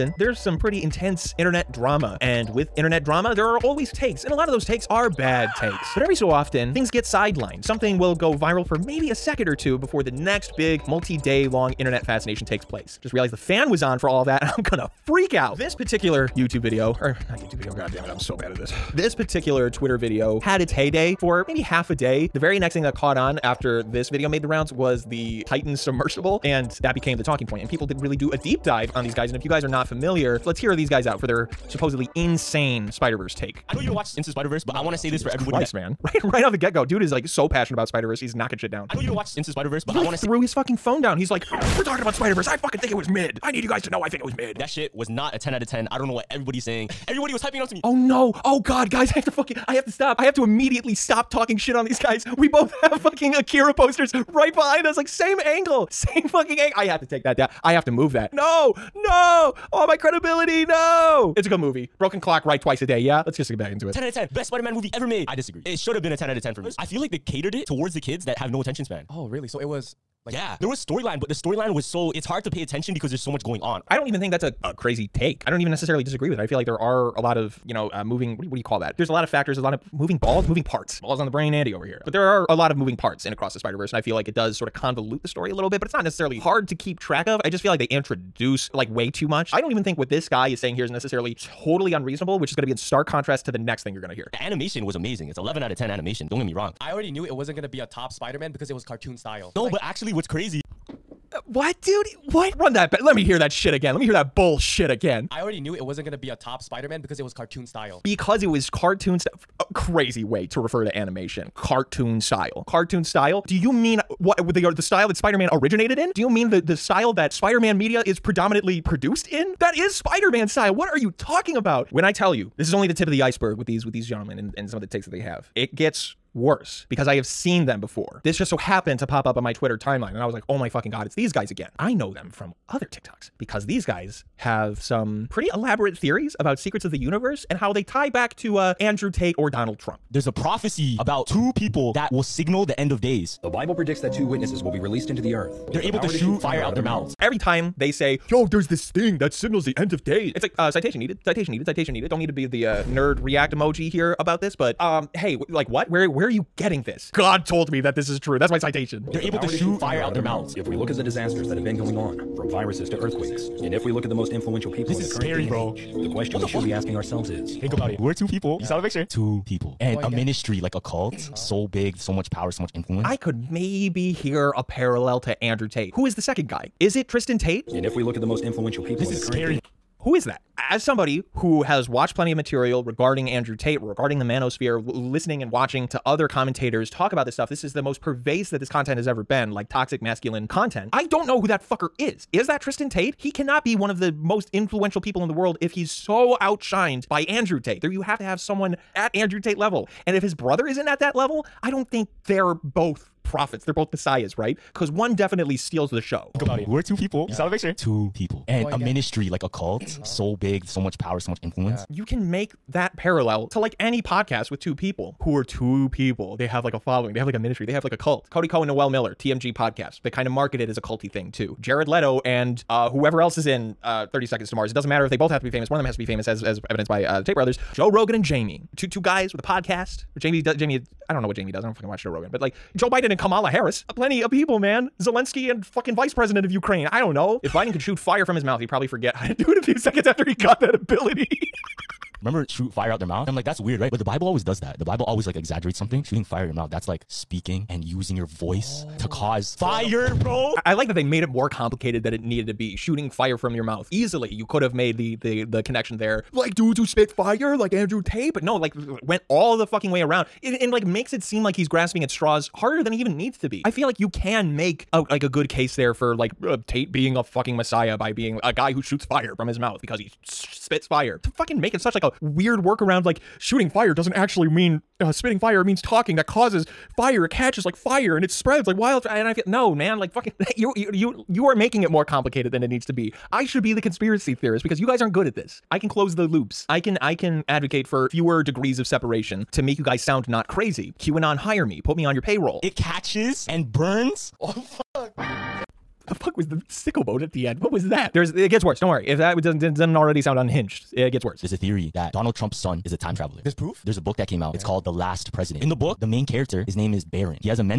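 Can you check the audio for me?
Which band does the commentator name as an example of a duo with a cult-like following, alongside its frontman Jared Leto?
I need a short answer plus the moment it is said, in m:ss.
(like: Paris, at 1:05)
30 Seconds to Mars, at 3:44.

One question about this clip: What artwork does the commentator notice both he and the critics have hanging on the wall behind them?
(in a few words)
Akira posters.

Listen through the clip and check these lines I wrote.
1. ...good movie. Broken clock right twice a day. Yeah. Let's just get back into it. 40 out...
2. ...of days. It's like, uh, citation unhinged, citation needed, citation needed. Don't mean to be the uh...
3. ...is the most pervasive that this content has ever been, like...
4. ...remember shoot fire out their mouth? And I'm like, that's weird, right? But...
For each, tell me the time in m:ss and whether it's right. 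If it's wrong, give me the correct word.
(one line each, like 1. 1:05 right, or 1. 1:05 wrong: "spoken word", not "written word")
1. 1:01 wrong: "10", not "40"
2. 2:29 wrong: "needed", not "unhinged"
3. 3:07 right
4. 4:02 right.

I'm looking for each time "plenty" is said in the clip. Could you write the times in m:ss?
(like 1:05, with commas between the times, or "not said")
3:02, 3:53.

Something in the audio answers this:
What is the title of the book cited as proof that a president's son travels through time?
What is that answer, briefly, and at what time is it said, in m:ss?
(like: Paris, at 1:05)
The Last President, at 5:04.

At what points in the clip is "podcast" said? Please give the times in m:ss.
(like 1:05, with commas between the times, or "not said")
3:34, 3:39, 3:49.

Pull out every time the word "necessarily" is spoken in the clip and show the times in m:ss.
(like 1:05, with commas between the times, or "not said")
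1:15, 1:26, 1:30.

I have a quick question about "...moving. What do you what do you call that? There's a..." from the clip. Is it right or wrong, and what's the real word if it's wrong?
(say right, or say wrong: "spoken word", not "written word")
right.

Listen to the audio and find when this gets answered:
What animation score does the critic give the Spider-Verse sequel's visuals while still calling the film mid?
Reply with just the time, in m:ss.
1:35.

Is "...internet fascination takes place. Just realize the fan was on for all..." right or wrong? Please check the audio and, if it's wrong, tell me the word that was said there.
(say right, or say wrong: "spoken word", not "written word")
right.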